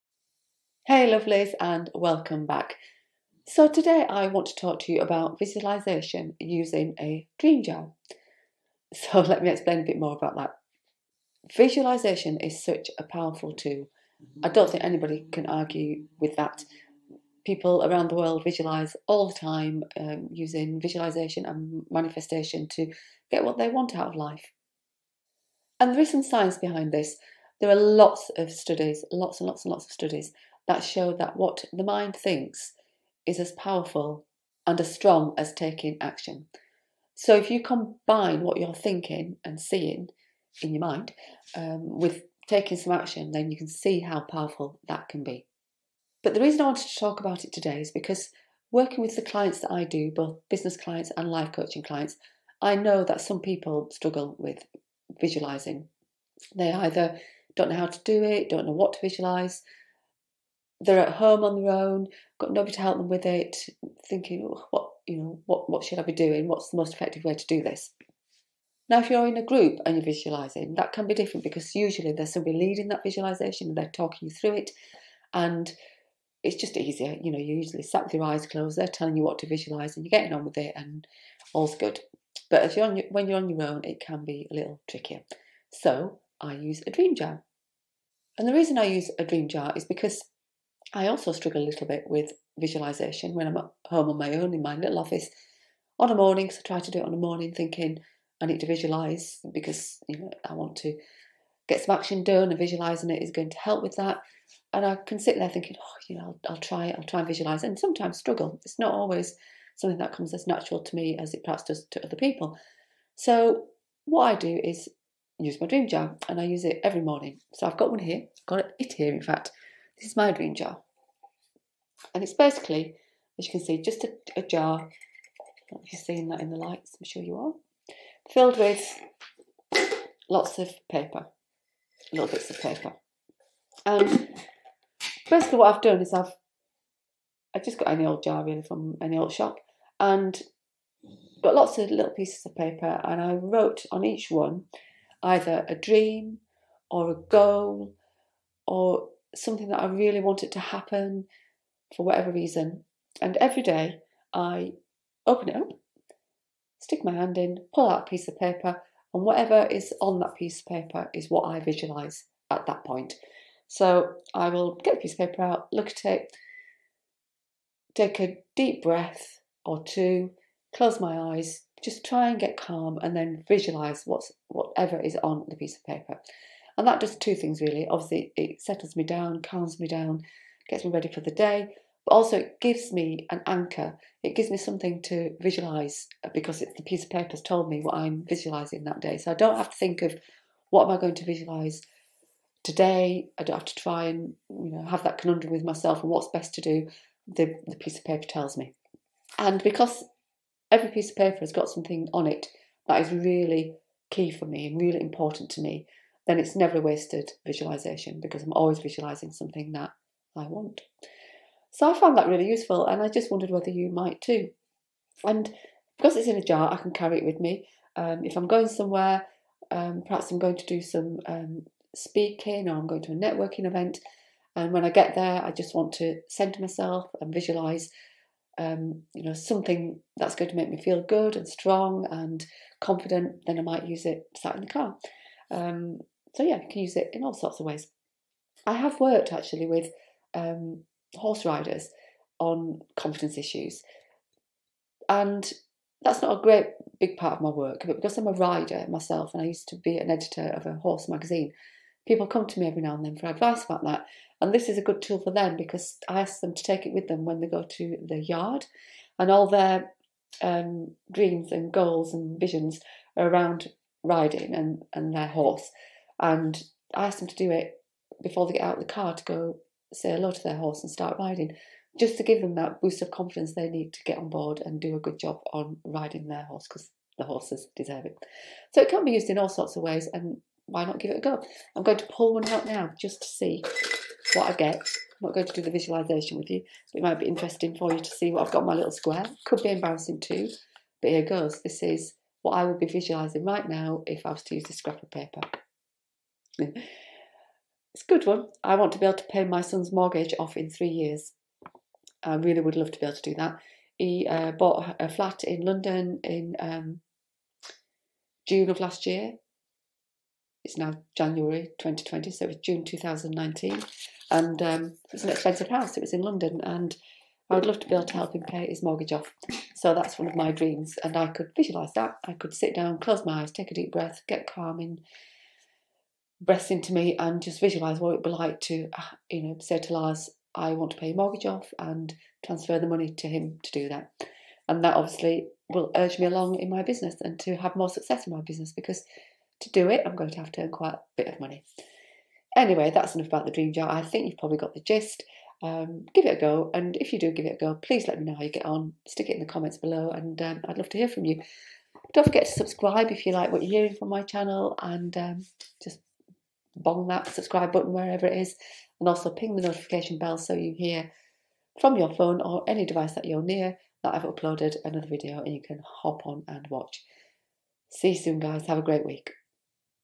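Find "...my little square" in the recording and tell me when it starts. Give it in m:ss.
4:48.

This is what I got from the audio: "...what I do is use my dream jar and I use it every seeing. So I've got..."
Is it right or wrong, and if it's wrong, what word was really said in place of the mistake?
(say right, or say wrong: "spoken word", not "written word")
wrong: "morning", not "seeing".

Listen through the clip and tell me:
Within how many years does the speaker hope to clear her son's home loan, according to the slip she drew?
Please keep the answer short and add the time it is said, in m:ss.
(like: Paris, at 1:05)
3, at 5:00.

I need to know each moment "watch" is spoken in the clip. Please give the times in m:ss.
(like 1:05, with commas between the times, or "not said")
6:06.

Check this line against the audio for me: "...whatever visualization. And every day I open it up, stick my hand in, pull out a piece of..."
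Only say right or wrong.
wrong.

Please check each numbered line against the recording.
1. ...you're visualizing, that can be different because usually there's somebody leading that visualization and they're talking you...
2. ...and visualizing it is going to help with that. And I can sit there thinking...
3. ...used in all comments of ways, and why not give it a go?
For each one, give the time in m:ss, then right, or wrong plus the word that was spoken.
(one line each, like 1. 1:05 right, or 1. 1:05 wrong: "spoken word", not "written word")
1. 1:09 right
2. 1:42 right
3. 4:39 wrong: "sorts", not "comments".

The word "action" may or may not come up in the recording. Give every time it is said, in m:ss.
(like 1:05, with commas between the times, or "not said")
0:35, 0:42, 1:41.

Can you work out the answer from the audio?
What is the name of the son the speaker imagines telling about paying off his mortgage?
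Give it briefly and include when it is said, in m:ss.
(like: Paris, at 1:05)
Lars, at 5:29.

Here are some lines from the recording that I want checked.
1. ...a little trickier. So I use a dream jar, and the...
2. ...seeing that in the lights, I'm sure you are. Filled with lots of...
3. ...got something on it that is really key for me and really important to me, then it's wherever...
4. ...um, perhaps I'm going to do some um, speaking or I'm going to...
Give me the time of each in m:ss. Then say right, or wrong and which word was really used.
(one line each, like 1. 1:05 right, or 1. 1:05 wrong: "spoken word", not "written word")
1. 1:24 right
2. 2:06 right
3. 3:21 wrong: "never", not "wherever"
4. 3:39 right.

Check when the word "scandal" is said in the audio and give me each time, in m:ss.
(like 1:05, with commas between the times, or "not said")
not said.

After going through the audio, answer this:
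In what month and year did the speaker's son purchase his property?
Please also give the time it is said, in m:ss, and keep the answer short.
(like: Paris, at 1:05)
June 2019, at 5:12.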